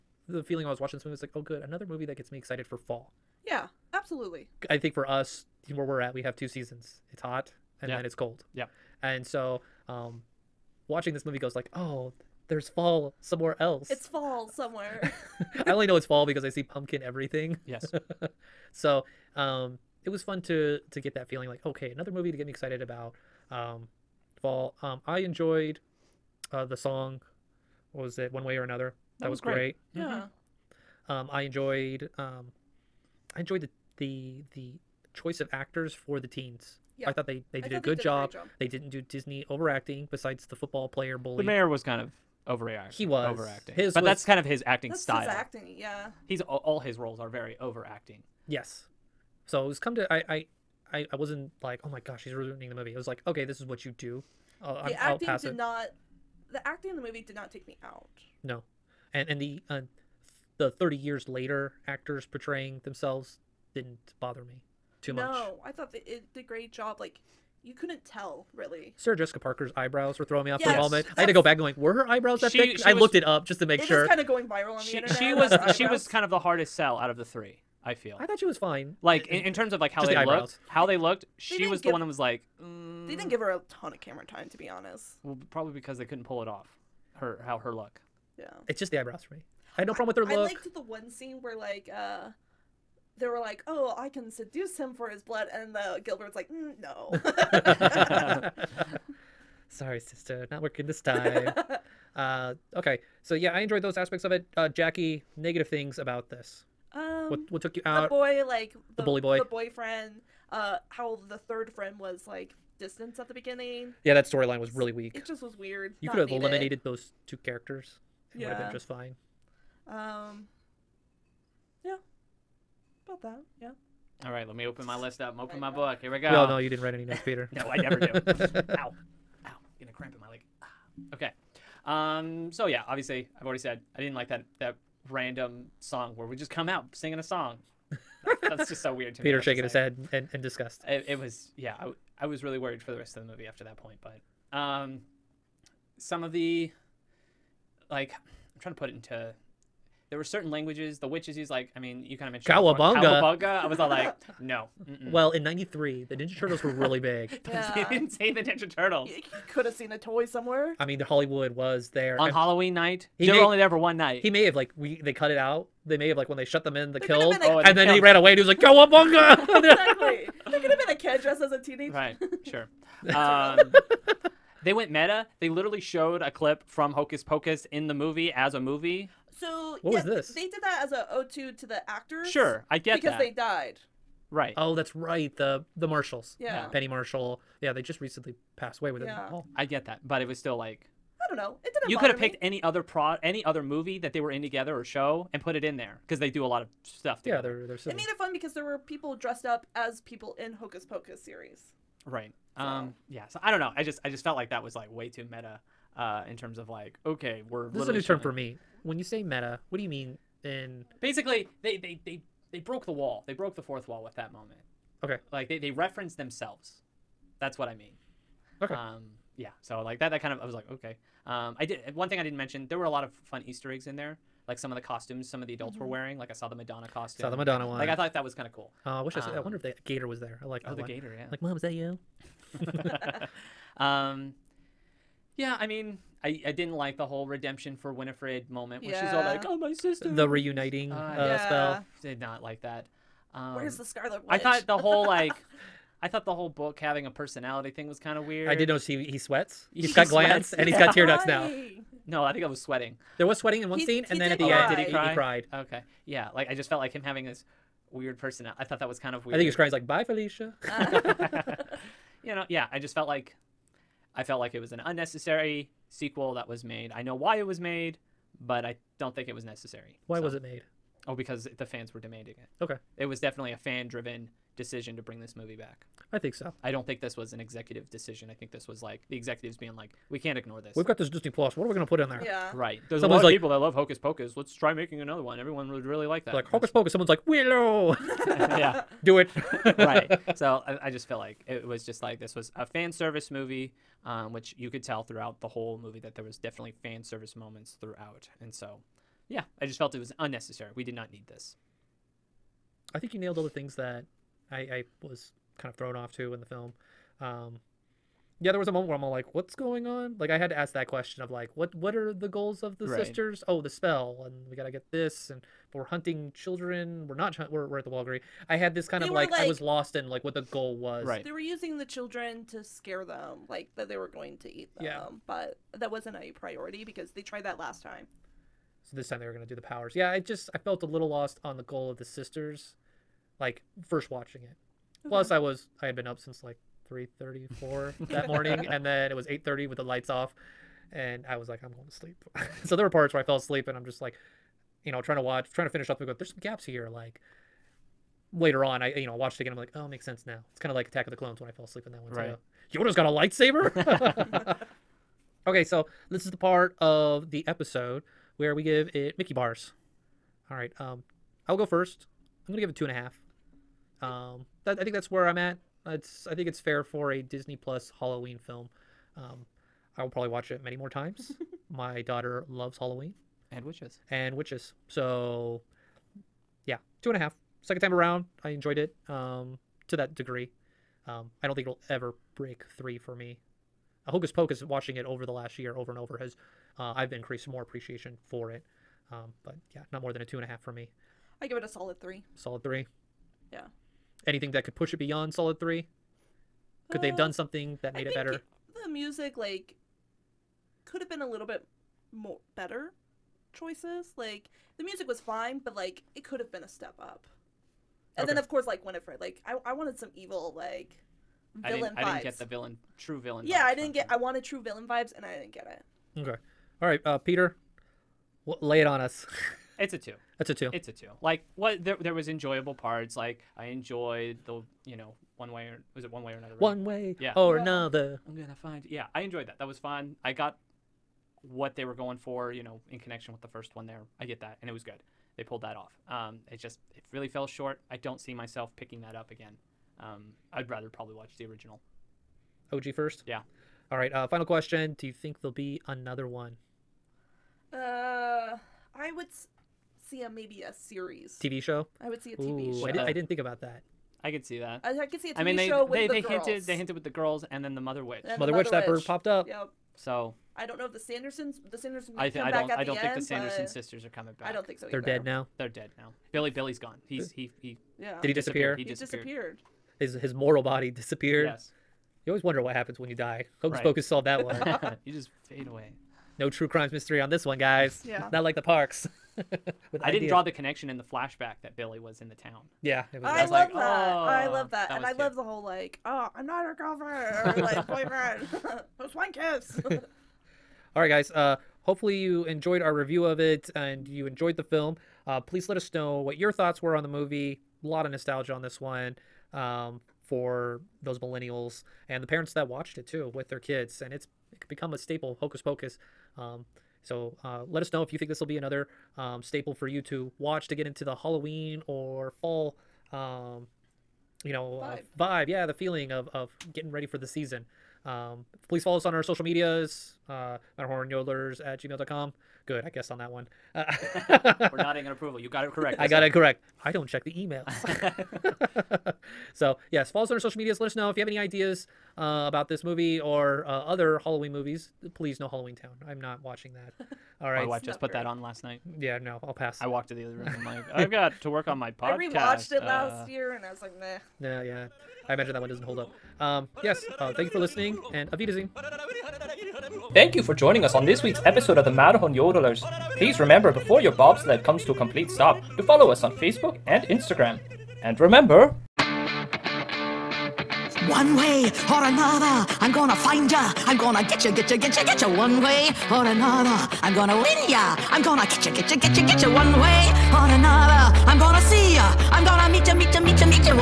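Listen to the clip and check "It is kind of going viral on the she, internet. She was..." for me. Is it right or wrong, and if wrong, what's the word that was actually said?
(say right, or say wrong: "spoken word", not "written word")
right.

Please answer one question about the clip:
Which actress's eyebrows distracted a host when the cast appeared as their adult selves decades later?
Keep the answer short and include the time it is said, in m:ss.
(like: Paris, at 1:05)
Sarah Jessica Parker, at 1:08.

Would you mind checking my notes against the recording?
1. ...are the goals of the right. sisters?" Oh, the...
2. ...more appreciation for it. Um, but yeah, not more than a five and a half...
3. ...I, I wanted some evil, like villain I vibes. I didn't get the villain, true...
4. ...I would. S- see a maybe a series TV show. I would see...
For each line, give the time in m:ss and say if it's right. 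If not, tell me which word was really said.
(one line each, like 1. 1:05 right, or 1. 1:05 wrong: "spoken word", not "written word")
1. 5:11 right
2. 6:27 wrong: "two", not "five"
3. 6:49 right
4. 7:28 right.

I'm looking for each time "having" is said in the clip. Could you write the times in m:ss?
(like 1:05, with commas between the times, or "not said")
4:06, 4:17.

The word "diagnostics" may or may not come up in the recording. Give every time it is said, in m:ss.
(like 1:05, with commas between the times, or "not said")
not said.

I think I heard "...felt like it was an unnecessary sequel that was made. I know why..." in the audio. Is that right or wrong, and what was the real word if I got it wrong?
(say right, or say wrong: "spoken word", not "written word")
right.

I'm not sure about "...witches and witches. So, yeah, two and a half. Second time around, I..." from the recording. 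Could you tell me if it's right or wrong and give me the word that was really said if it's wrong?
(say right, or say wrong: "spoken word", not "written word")
right.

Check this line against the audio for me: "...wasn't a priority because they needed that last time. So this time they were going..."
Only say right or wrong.
wrong.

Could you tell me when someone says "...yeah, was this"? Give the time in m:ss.
2:59.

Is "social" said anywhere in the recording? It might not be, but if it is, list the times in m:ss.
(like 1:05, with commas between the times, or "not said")
8:39, 8:50.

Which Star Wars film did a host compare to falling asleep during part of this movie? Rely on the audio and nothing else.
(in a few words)
Attack of the Clones.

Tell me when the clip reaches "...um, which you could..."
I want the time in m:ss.
4:54.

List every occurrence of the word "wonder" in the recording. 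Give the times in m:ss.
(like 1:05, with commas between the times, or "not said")
3:49, 7:52.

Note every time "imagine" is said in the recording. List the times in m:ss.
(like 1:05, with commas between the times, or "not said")
9:05.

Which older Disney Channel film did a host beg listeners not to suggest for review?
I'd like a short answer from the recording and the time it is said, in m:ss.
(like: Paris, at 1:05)
Halloween Town, at 8:55.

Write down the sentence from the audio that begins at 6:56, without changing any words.
Okay, all right, uh, Peter, lay it on us.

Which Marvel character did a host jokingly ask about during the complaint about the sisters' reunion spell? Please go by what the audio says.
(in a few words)
Scarlet Witch.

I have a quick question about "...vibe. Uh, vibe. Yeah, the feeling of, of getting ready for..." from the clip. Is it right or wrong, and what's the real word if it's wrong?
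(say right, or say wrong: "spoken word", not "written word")
right.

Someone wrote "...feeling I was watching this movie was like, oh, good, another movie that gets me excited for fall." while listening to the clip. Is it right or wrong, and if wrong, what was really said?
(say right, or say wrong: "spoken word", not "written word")
right.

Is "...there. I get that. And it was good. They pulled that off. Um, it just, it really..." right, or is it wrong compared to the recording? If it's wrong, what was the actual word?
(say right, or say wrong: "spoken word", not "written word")
right.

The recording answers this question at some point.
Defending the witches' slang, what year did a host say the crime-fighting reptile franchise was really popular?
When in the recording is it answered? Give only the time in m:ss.
2:35.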